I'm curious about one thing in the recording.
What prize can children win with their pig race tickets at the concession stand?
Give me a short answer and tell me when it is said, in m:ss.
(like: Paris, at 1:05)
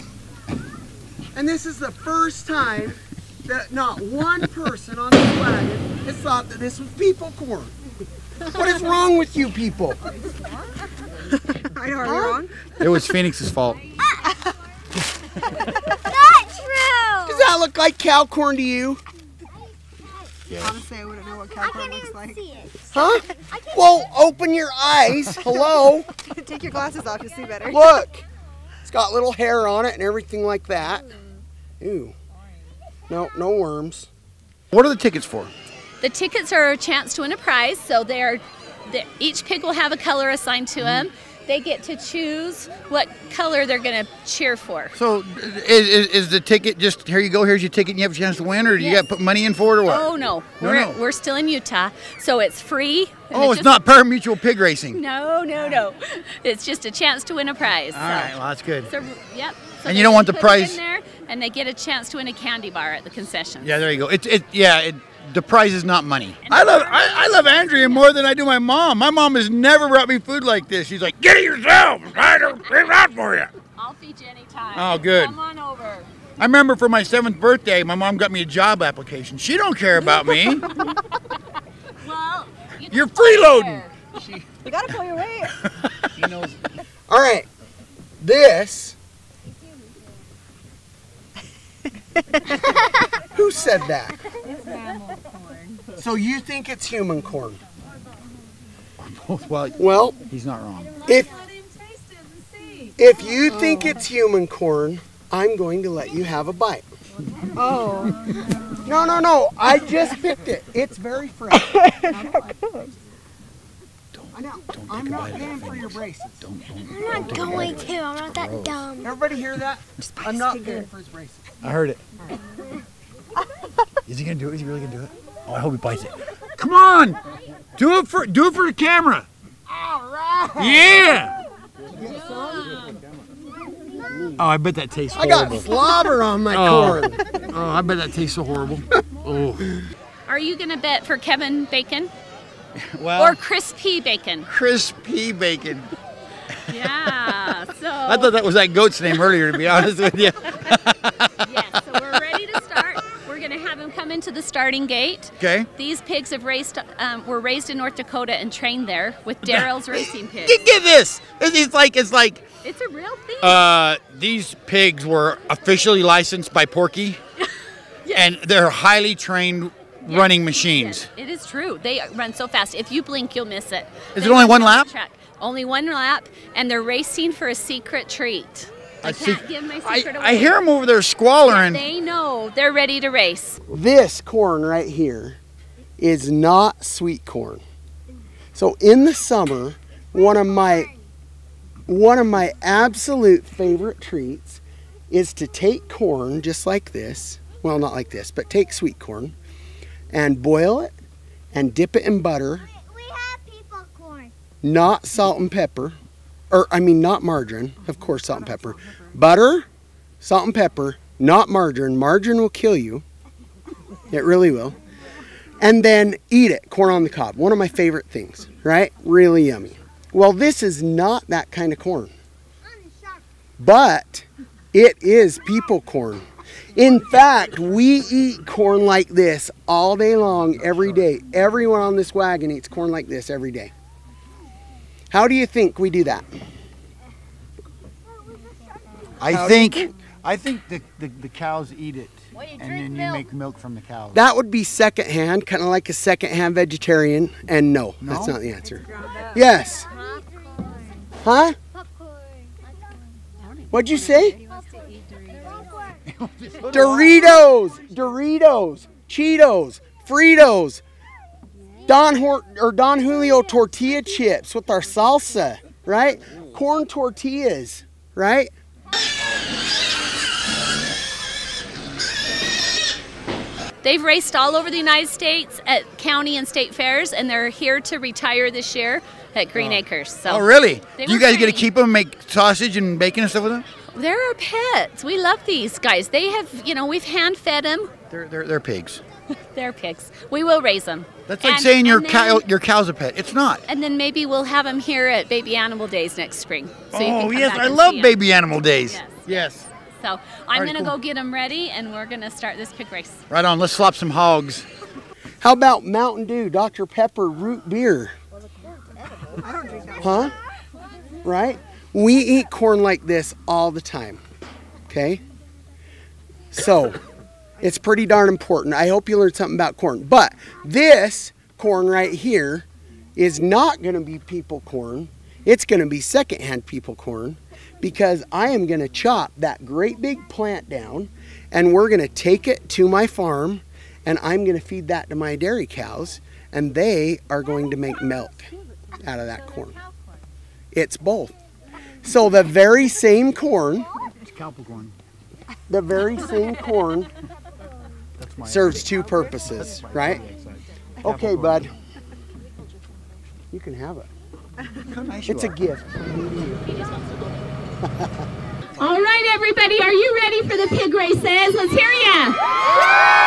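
A candy bar, at 1:02.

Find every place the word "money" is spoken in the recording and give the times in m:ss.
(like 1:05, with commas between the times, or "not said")
0:49, 1:06.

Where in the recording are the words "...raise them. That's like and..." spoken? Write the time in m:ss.
4:50.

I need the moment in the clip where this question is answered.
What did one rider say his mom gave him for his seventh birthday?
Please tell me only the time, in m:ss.
1:18.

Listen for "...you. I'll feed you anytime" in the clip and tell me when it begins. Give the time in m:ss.
1:13.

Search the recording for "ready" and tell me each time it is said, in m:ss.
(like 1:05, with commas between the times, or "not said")
2:32, 3:02, 5:01, 6:00.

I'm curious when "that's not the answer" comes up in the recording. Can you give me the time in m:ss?
4:08.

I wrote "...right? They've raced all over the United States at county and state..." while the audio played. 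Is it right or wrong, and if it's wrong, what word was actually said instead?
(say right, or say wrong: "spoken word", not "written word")
right.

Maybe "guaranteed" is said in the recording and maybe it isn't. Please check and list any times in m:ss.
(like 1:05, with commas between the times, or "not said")
not said.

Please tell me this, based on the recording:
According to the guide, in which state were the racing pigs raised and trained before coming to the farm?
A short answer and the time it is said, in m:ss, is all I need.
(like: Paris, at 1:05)
North Dakota, at 2:37.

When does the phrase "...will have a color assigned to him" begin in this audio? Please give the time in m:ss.
0:39.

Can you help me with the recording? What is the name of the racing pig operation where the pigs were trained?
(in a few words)
Daryl's racing pigs.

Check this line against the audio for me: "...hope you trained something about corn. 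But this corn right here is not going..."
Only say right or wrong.
wrong.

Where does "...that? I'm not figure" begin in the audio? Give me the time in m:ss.
1:59.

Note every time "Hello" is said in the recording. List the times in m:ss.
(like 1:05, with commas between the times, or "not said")
0:25.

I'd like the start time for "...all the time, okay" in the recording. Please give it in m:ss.
5:13.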